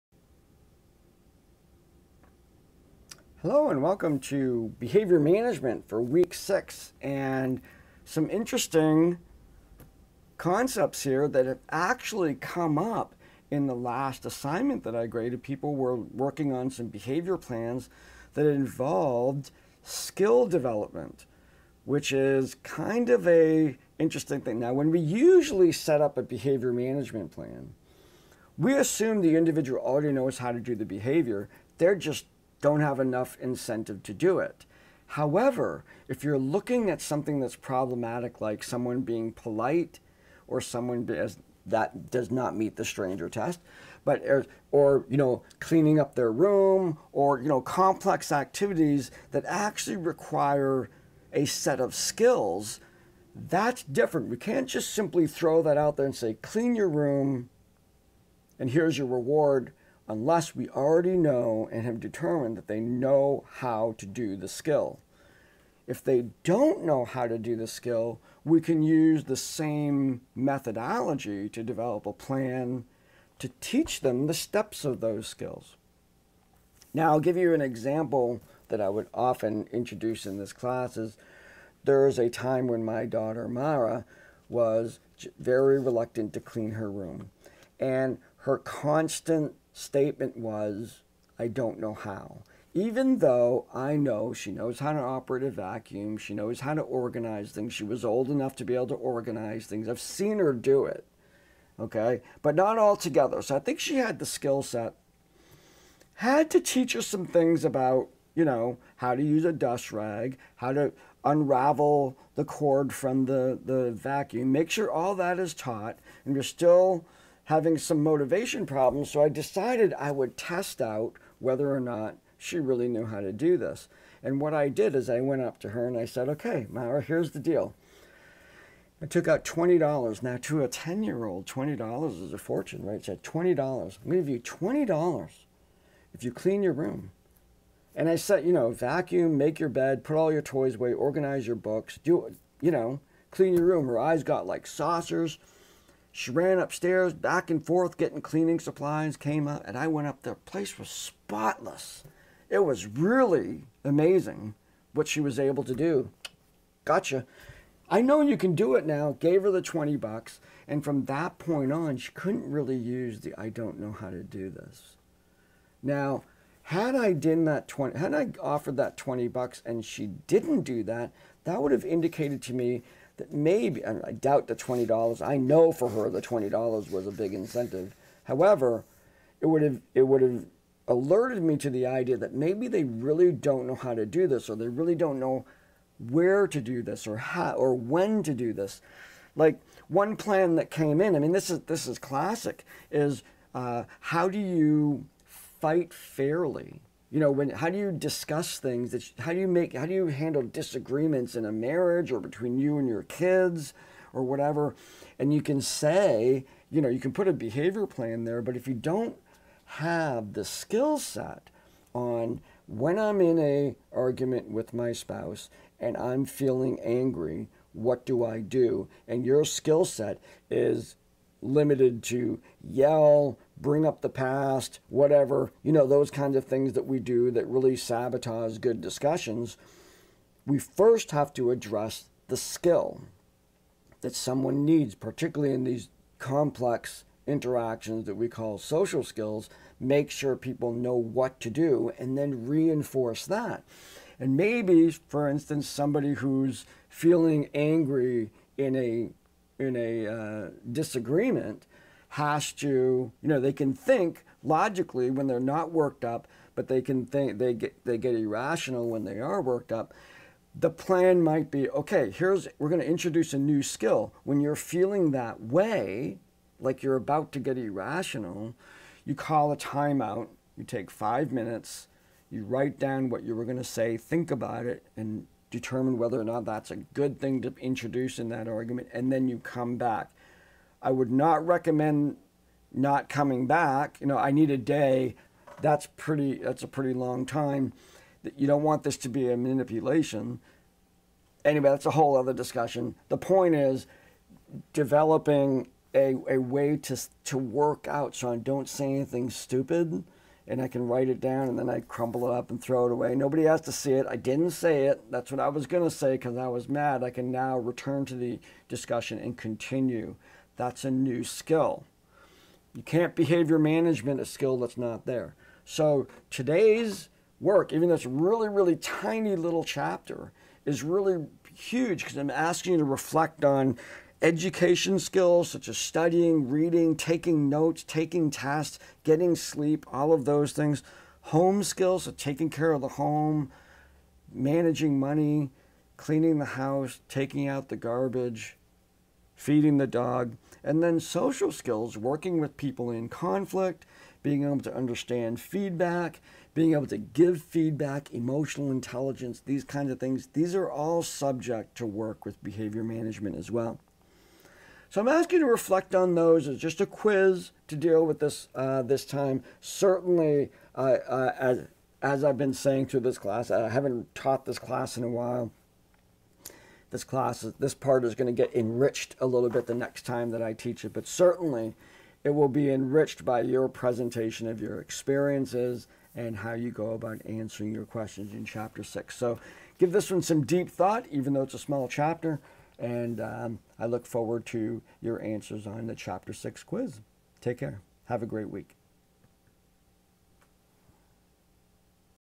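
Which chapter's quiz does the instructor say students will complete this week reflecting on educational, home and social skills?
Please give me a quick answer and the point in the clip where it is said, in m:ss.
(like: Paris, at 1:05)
Chapter 6, at 6:25.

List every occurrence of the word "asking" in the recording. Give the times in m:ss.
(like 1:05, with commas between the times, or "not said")
5:22, 5:55.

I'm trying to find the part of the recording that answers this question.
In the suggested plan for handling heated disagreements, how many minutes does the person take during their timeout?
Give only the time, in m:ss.
4:30.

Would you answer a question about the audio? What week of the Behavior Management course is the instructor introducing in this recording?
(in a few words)
Week 6.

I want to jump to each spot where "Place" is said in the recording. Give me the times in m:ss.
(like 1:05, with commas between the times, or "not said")
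2:30.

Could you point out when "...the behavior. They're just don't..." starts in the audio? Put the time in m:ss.
0:30.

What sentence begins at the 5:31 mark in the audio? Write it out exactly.
Home skills, so taking care of the home, managing money, cleaning the house, taking out the garbage, feeding the dog.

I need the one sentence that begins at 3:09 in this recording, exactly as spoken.
Like one plan that came in, I mean, this is, this is classic, is uh, how do you fight fairly?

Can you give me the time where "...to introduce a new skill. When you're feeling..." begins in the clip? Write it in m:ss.
4:22.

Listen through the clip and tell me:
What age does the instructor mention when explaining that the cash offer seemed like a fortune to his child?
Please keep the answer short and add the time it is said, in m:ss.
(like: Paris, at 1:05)
10, at 2:10.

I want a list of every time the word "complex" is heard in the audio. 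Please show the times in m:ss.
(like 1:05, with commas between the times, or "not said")
0:47, 3:56.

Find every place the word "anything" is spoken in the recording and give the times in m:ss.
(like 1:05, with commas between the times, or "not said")
4:58.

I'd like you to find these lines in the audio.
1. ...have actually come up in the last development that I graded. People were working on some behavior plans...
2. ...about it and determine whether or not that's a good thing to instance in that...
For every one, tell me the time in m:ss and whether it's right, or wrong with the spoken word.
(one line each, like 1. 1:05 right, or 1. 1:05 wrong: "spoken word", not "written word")
1. 0:11 wrong: "assignment", not "development"
2. 4:34 wrong: "introduce", not "instance".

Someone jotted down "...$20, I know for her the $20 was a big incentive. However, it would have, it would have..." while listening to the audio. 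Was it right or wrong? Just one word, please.
right.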